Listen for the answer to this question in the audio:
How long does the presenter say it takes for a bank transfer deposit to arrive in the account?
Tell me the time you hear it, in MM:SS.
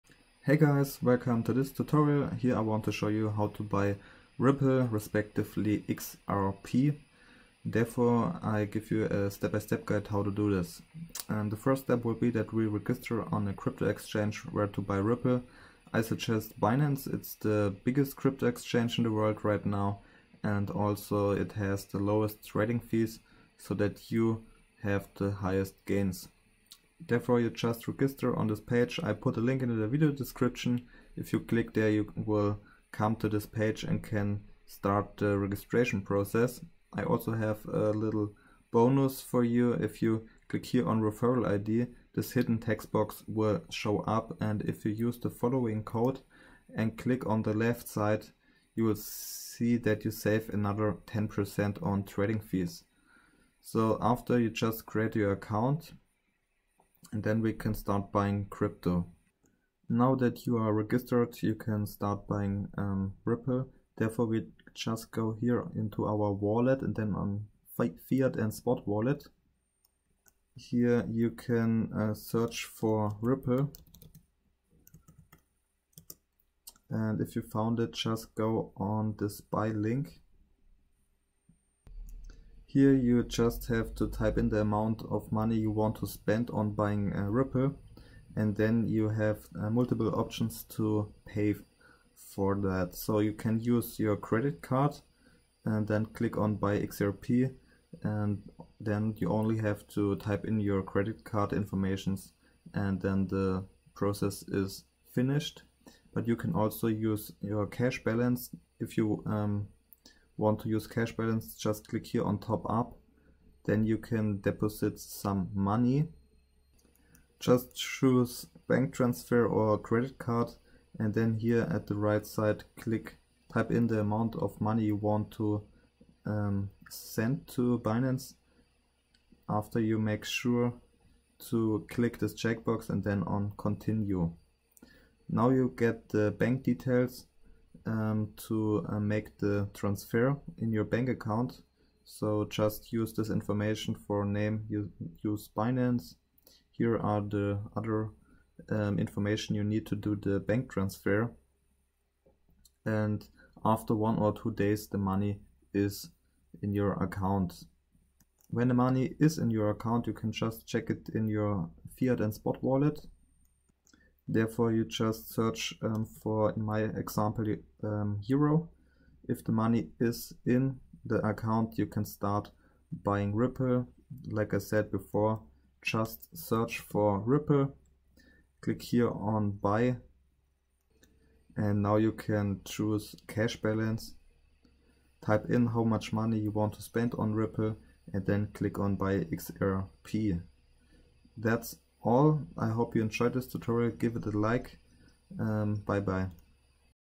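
02:33.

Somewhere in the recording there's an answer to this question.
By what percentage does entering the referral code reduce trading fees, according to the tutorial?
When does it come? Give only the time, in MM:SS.
00:51.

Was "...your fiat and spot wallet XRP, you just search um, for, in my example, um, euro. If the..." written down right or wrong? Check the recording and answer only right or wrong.
wrong.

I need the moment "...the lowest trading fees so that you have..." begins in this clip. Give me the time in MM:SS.
00:21.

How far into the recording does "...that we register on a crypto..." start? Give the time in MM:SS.
00:12.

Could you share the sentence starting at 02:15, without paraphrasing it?
Now you get the bank details um, to uh, make the transfer in your bank account.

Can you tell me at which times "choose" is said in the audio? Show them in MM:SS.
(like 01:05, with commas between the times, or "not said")
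01:57, 03:02.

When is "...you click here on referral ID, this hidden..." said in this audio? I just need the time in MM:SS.
00:40.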